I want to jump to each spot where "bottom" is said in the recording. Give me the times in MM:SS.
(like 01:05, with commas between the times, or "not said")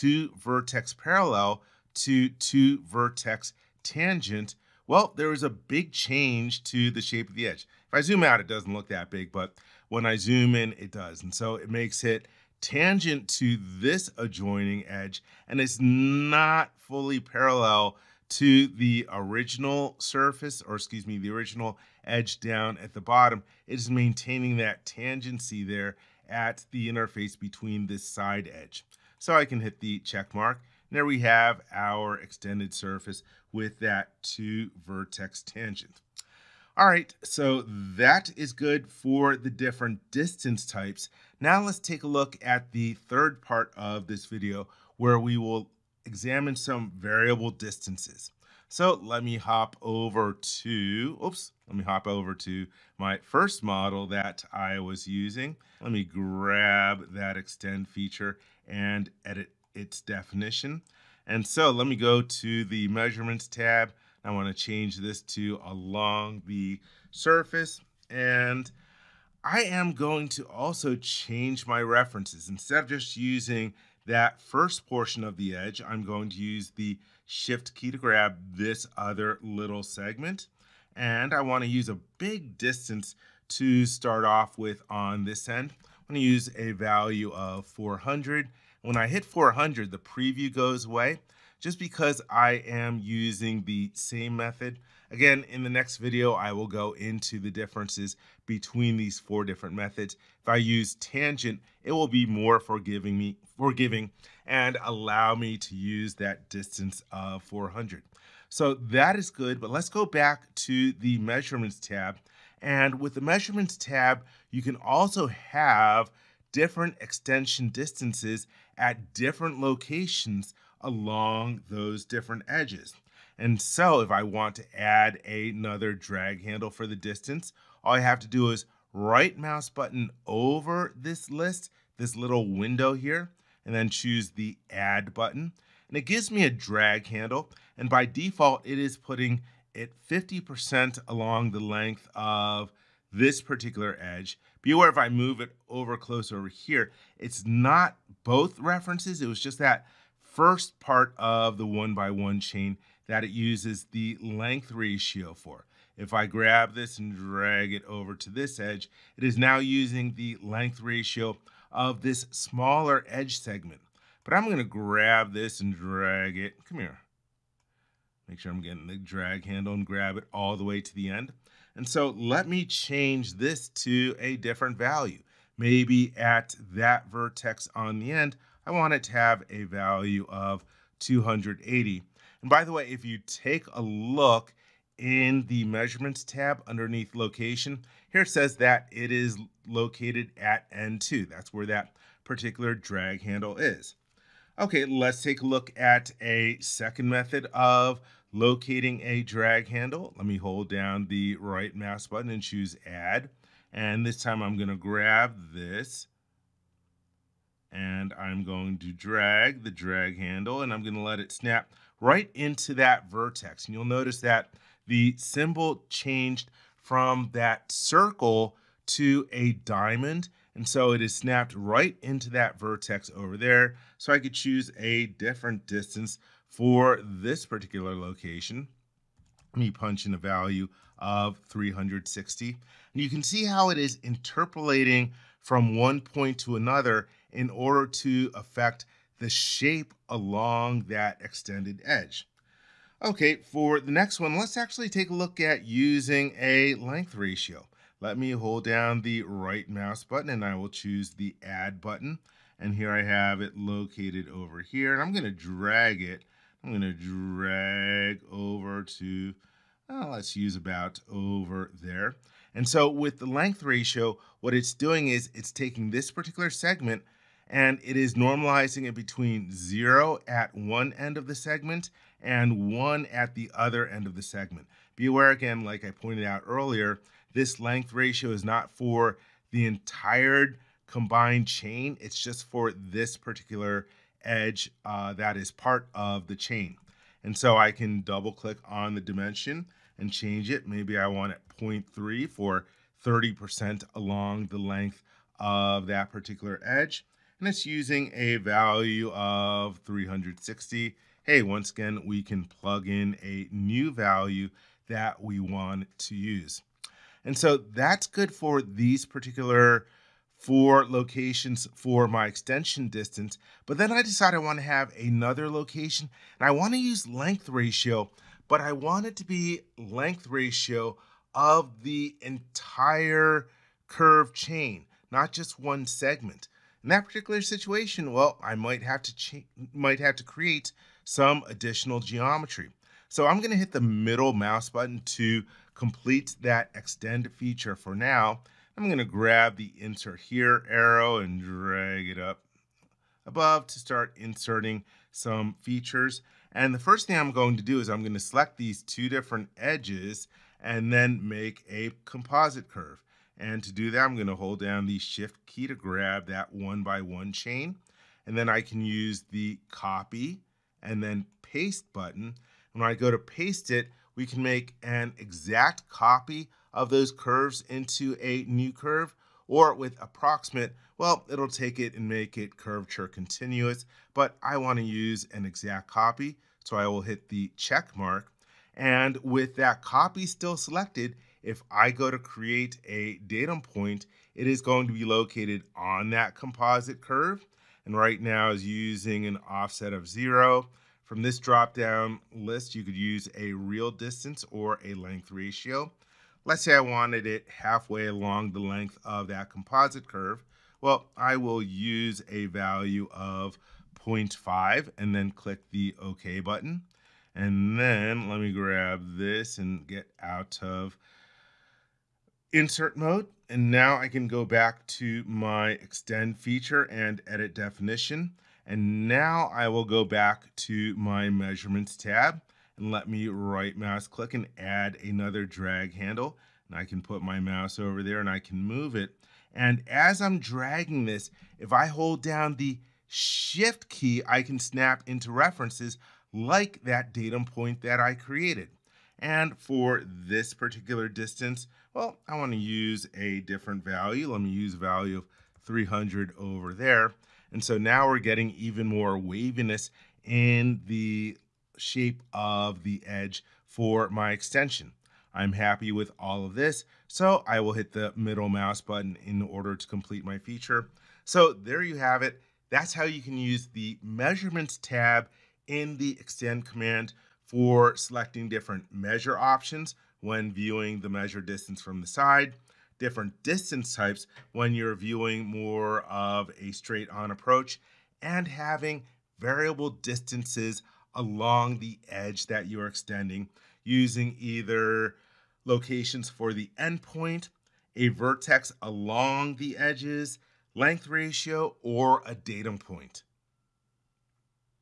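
00:23.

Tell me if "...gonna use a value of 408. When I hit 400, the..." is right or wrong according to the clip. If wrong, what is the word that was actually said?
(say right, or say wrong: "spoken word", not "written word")
wrong: "400", not "408".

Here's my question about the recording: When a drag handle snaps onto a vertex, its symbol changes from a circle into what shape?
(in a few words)
Diamond.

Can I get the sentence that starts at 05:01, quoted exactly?
Hey, once again, we can plug in a new value that we want to use.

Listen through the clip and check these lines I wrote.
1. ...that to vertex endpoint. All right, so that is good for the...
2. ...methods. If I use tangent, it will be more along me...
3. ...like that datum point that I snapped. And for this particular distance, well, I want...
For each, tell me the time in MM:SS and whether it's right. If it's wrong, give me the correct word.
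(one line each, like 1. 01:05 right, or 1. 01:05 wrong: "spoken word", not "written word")
1. 00:33 wrong: "tangent", not "endpoint"
2. 01:39 wrong: "forgiving", not "along"
3. 07:16 wrong: "created", not "snapped".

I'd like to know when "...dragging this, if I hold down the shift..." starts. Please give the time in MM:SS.
07:10.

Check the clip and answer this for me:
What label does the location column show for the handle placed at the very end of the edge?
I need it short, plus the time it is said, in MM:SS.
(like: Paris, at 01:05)
N2, at 03:10.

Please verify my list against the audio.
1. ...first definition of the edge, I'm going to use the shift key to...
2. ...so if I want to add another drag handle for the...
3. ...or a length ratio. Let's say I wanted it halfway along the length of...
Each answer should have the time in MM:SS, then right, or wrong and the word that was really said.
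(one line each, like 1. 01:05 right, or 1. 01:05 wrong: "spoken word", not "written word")
1. 01:14 wrong: "portion", not "definition"
2. 02:03 right
3. 06:34 right.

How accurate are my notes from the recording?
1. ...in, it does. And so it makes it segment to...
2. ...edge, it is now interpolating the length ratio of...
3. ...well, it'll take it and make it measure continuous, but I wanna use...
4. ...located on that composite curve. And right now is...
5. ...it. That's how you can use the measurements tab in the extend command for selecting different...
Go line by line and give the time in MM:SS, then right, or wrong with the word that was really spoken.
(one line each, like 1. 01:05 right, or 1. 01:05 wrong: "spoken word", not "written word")
1. 00:10 wrong: "tangent", not "segment"
2. 02:38 wrong: "using", not "interpolating"
3. 06:10 wrong: "curvature", not "measure"
4. 06:25 right
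5. 07:42 right.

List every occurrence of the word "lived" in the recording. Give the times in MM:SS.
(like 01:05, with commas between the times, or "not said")
not said.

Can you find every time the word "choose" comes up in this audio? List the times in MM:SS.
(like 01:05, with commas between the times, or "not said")
02:13, 03:22, 03:44, 04:10.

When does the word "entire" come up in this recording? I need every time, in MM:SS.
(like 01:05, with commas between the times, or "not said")
04:39, 05:22.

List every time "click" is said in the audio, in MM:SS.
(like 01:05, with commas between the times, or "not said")
04:48, 06:45, 07:04.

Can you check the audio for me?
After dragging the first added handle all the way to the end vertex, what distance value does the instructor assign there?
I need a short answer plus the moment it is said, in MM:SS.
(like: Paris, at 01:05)
280, at 03:01.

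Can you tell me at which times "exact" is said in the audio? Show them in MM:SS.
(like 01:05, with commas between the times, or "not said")
06:05, 06:15.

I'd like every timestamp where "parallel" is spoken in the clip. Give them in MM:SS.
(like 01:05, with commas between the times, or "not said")
00:00, 00:17.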